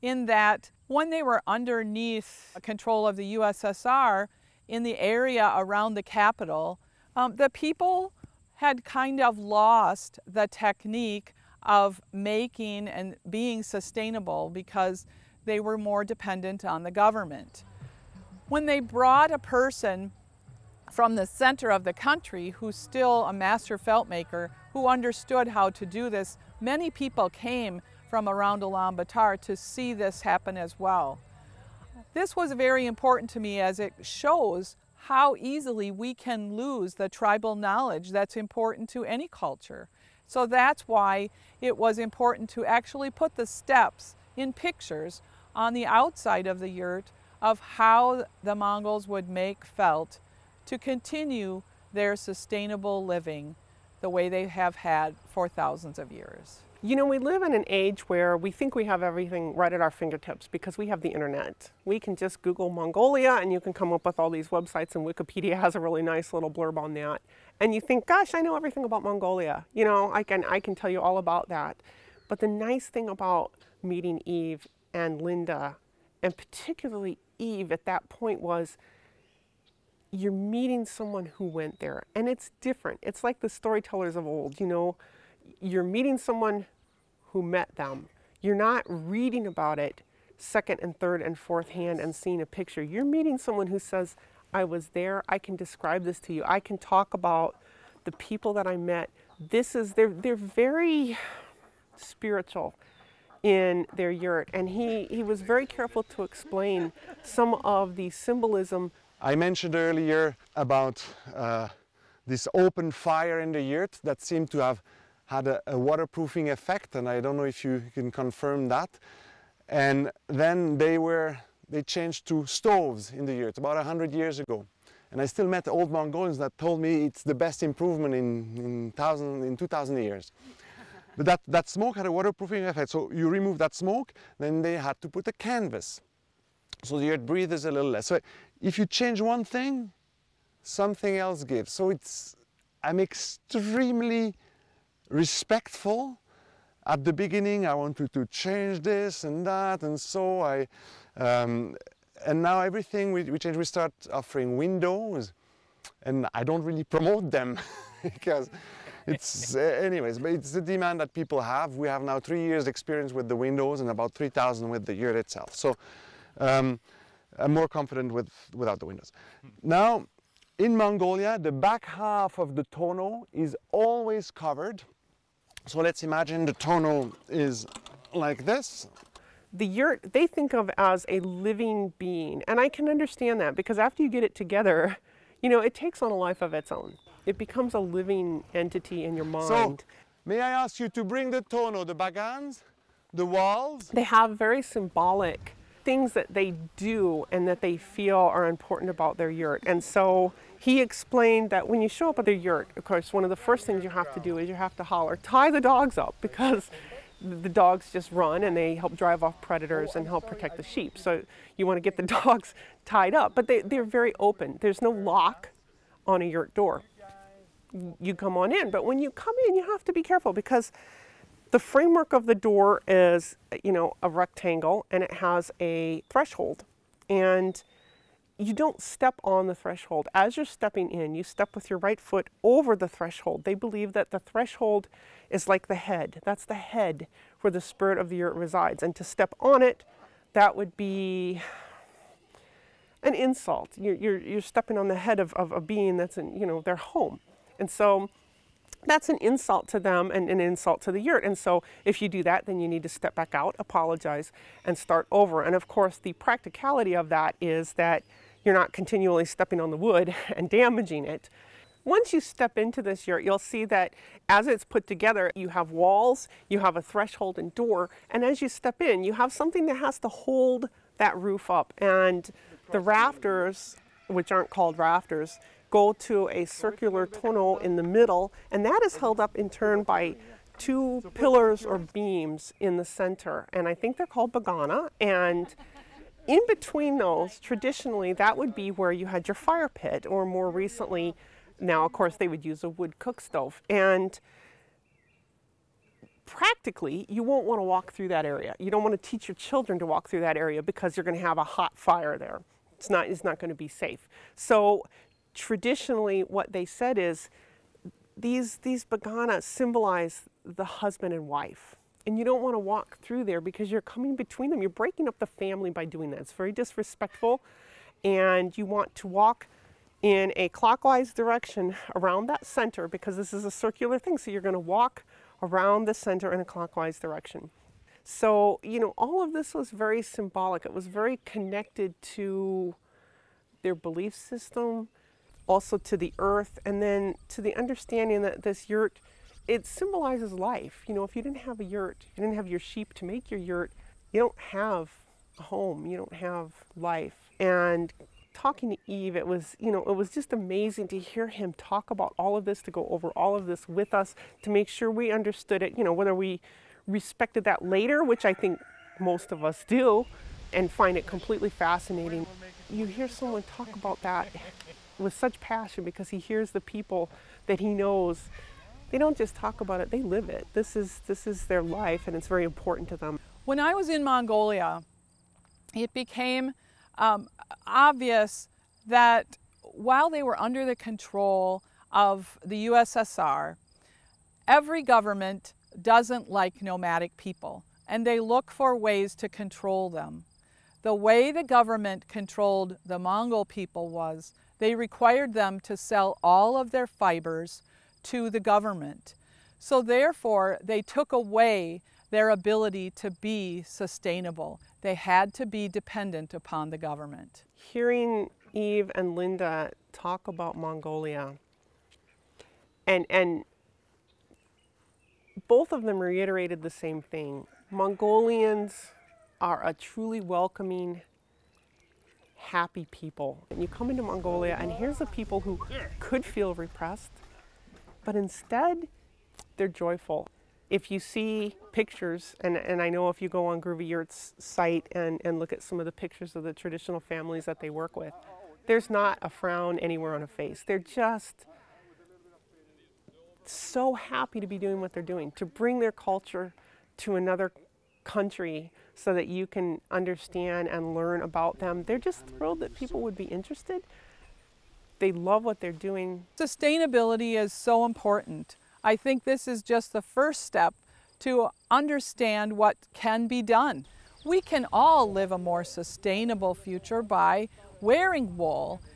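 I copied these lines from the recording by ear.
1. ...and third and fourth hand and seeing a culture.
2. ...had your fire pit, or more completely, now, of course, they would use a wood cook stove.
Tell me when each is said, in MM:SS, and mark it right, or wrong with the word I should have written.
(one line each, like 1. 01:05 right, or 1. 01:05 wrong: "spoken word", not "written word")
1. 01:30 wrong: "picture", not "culture"
2. 04:49 wrong: "recently", not "completely".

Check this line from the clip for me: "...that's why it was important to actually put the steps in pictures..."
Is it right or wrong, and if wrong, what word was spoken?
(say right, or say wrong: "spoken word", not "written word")
right.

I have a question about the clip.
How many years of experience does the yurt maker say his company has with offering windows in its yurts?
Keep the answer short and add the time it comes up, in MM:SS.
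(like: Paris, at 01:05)
3 years, at 02:42.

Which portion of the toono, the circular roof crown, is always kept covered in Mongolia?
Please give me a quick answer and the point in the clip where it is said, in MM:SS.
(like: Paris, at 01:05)
The back half, at 02:51.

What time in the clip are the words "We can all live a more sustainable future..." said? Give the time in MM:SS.
07:44.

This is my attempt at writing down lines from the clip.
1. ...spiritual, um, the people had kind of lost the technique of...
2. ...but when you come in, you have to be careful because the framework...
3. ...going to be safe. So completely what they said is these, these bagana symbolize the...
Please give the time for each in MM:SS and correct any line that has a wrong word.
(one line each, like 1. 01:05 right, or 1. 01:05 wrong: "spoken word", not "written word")
1. 00:06 wrong: "capital", not "spiritual"
2. 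03:38 right
3. 05:03 wrong: "traditionally", not "completely".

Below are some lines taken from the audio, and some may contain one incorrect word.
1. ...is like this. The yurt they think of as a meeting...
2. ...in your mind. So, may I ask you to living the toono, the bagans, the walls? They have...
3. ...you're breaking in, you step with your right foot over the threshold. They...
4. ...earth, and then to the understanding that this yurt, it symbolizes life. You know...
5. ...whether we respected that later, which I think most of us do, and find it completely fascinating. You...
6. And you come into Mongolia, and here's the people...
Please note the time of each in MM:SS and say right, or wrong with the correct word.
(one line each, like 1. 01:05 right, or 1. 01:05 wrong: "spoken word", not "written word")
1. 02:57 wrong: "living", not "meeting"
2. 03:09 wrong: "bring", not "living"
3. 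03:50 wrong: "stepping", not "breaking"
4. 05:36 right
5. 05:55 right
6. 07:03 right.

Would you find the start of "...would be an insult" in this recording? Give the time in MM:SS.
04:00.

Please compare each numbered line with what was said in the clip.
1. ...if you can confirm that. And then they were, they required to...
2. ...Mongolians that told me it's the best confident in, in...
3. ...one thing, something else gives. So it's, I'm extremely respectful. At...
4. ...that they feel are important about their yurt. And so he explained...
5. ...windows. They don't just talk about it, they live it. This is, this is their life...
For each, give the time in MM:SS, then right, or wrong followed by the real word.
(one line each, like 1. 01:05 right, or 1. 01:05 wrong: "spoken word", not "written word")
1. 01:57 wrong: "changed", not "required"
2. 02:05 wrong: "improvement", not "confident"
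3. 02:19 right
4. 03:17 right
5. 06:07 wrong: "knows", not "windows".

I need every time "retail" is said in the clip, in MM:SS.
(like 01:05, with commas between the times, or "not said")
not said.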